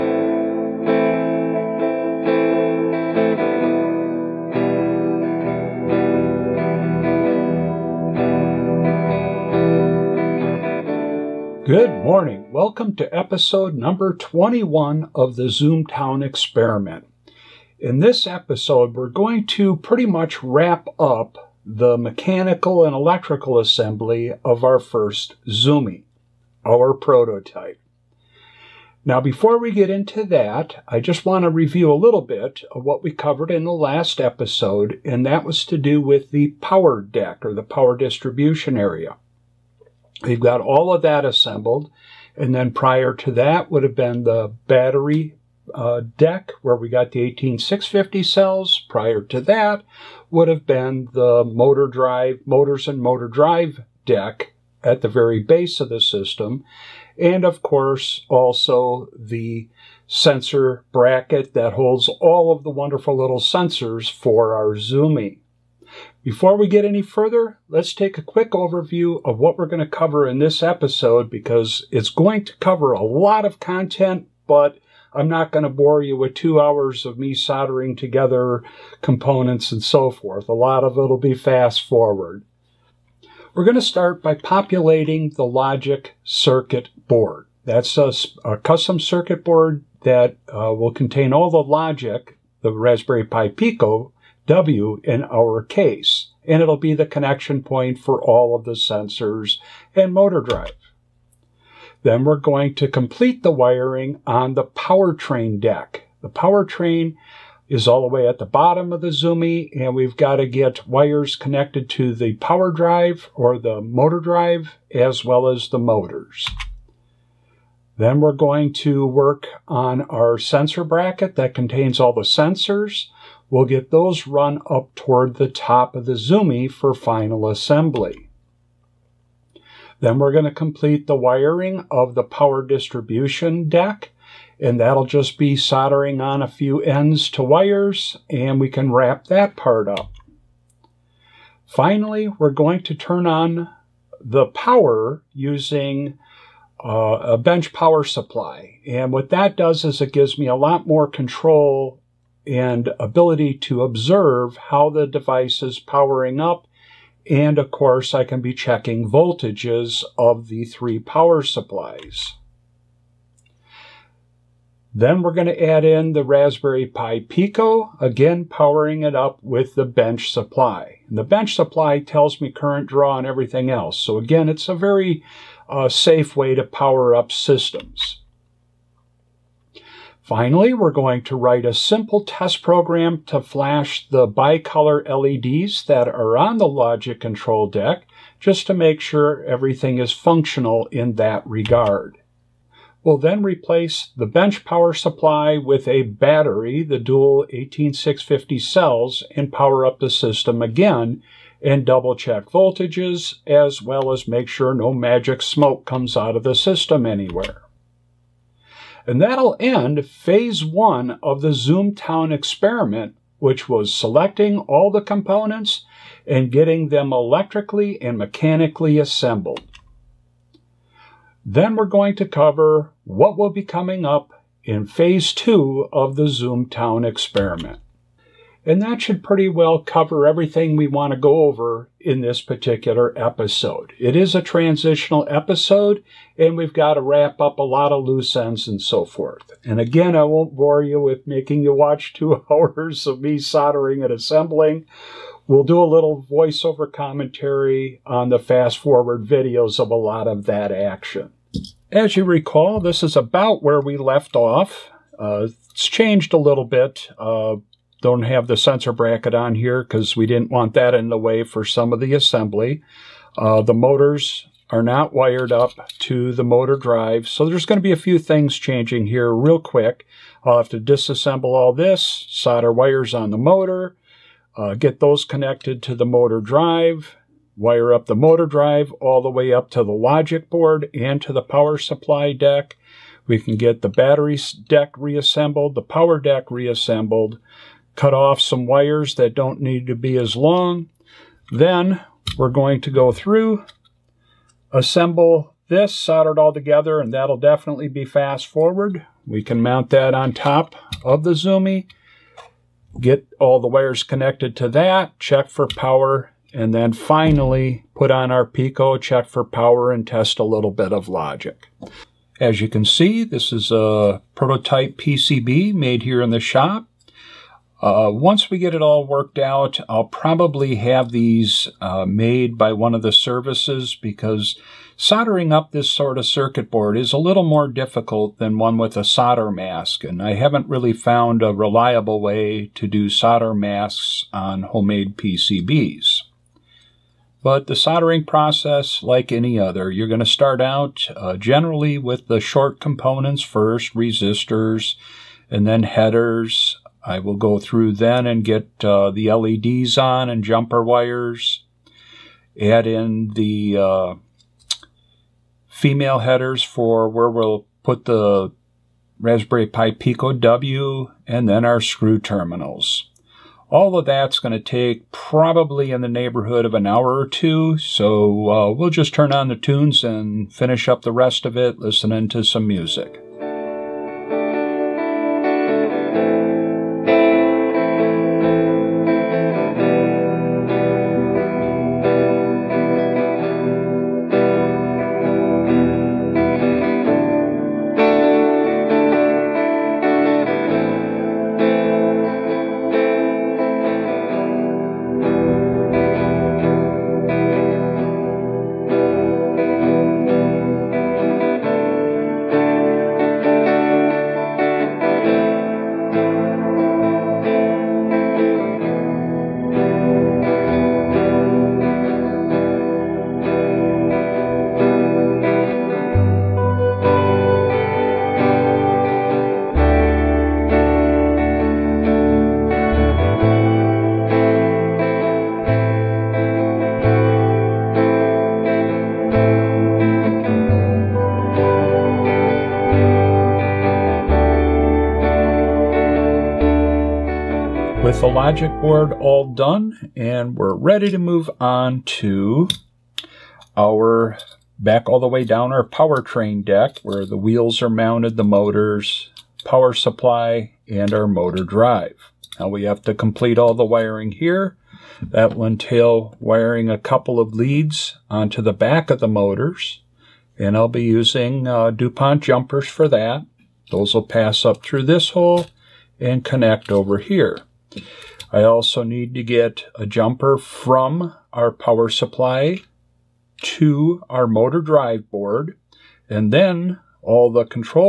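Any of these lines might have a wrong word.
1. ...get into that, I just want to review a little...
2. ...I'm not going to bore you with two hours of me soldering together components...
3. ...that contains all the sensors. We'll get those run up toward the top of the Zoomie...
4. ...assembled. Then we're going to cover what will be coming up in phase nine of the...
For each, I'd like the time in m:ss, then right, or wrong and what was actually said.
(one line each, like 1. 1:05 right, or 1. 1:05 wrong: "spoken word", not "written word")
1. 0:29 right
2. 1:15 right
3. 2:01 right
4. 3:38 wrong: "two", not "nine".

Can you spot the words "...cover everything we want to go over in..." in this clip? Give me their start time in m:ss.
3:49.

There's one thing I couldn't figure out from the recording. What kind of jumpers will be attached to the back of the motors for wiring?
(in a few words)
DuPont jumpers.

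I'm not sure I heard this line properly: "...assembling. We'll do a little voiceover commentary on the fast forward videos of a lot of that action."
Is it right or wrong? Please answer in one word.
right.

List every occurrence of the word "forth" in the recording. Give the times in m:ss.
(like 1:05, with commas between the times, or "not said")
1:20, 3:59.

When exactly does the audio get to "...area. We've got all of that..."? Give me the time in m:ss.
0:38.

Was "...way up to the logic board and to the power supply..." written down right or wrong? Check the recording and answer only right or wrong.
right.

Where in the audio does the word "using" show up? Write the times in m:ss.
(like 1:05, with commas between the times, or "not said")
2:25, 7:41.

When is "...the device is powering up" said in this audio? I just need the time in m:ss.
2:34.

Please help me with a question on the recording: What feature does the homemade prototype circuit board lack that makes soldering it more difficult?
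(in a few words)
solder mask.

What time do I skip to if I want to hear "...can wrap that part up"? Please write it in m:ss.
2:18.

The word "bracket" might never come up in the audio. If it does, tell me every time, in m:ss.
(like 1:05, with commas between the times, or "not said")
1:00, 2:00, 4:18.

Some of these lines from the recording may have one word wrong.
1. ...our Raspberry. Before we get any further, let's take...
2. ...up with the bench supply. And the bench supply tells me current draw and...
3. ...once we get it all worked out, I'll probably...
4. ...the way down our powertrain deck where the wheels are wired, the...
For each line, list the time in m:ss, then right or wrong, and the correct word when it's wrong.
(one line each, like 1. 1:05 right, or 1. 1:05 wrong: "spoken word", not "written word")
1. 1:04 wrong: "Zoomie", not "Raspberry"
2. 2:49 right
3. 5:18 right
4. 7:25 wrong: "mounted", not "wired".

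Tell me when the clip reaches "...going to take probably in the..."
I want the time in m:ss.
6:04.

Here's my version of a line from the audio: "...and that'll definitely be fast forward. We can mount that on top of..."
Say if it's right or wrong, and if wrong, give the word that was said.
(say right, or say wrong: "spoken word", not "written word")
right.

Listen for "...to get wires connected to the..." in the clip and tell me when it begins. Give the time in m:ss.
1:50.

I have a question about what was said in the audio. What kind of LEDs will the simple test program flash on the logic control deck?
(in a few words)
bicolor LEDs.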